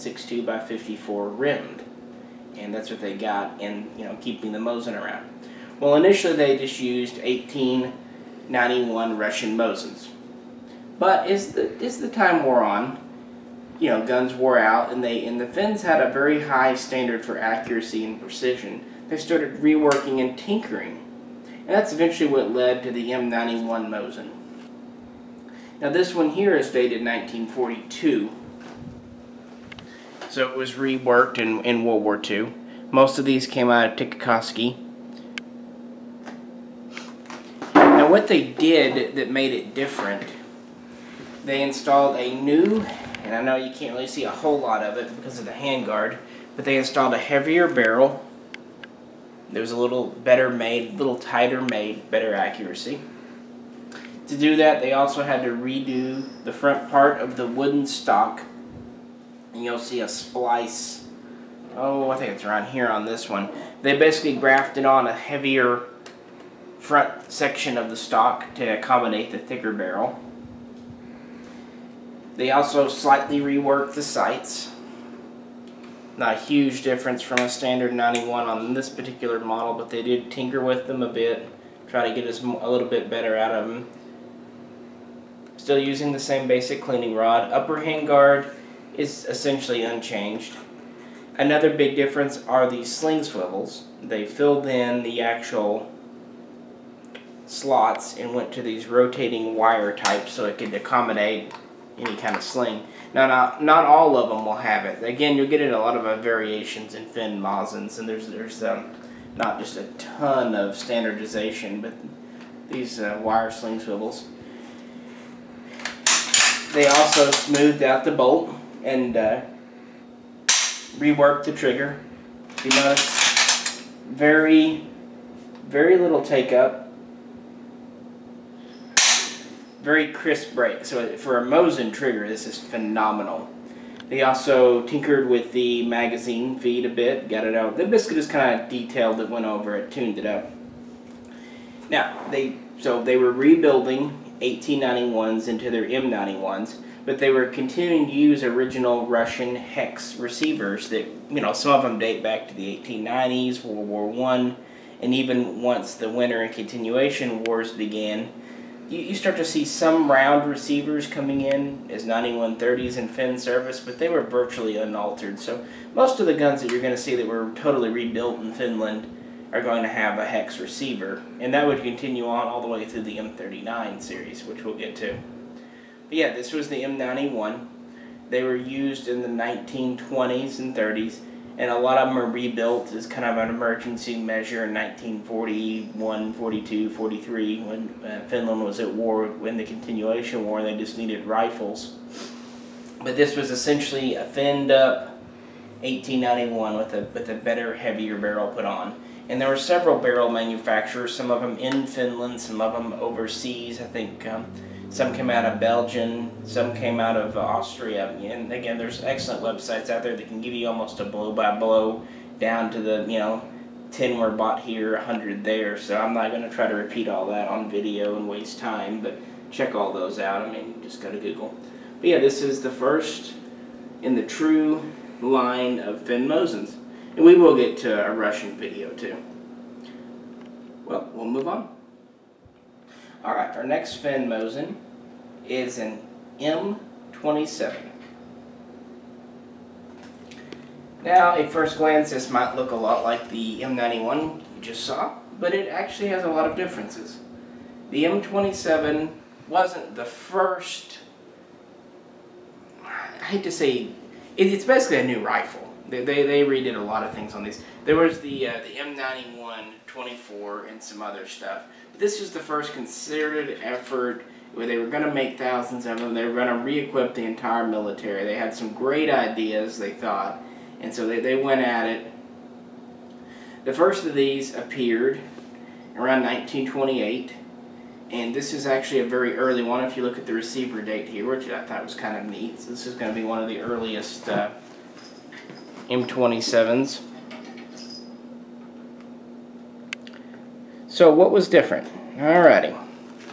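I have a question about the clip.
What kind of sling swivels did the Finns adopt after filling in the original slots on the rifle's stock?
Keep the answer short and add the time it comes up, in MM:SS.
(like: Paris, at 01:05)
Rotating wire types, at 01:38.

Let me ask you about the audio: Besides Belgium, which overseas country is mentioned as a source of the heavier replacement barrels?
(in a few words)
Austria.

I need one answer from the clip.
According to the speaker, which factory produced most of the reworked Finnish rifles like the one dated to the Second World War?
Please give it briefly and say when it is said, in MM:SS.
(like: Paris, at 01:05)
Tikkakoski, at 00:34.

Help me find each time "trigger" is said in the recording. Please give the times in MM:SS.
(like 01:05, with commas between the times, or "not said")
02:01, 02:11.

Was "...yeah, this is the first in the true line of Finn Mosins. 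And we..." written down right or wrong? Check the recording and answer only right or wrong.
right.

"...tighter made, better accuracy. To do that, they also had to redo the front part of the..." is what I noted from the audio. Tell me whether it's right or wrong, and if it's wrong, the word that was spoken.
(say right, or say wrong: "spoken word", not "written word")
right.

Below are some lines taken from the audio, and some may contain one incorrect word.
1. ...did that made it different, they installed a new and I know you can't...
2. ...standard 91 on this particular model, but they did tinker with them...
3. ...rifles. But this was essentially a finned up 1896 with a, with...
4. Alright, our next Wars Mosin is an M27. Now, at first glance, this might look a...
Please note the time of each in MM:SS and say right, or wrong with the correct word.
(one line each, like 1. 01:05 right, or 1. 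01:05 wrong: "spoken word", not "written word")
1. 00:38 right
2. 01:17 right
3. 03:11 wrong: "1891", not "1896"
4. 03:53 wrong: "Finn", not "Wars".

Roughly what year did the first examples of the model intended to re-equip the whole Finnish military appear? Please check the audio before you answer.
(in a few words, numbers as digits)
1928.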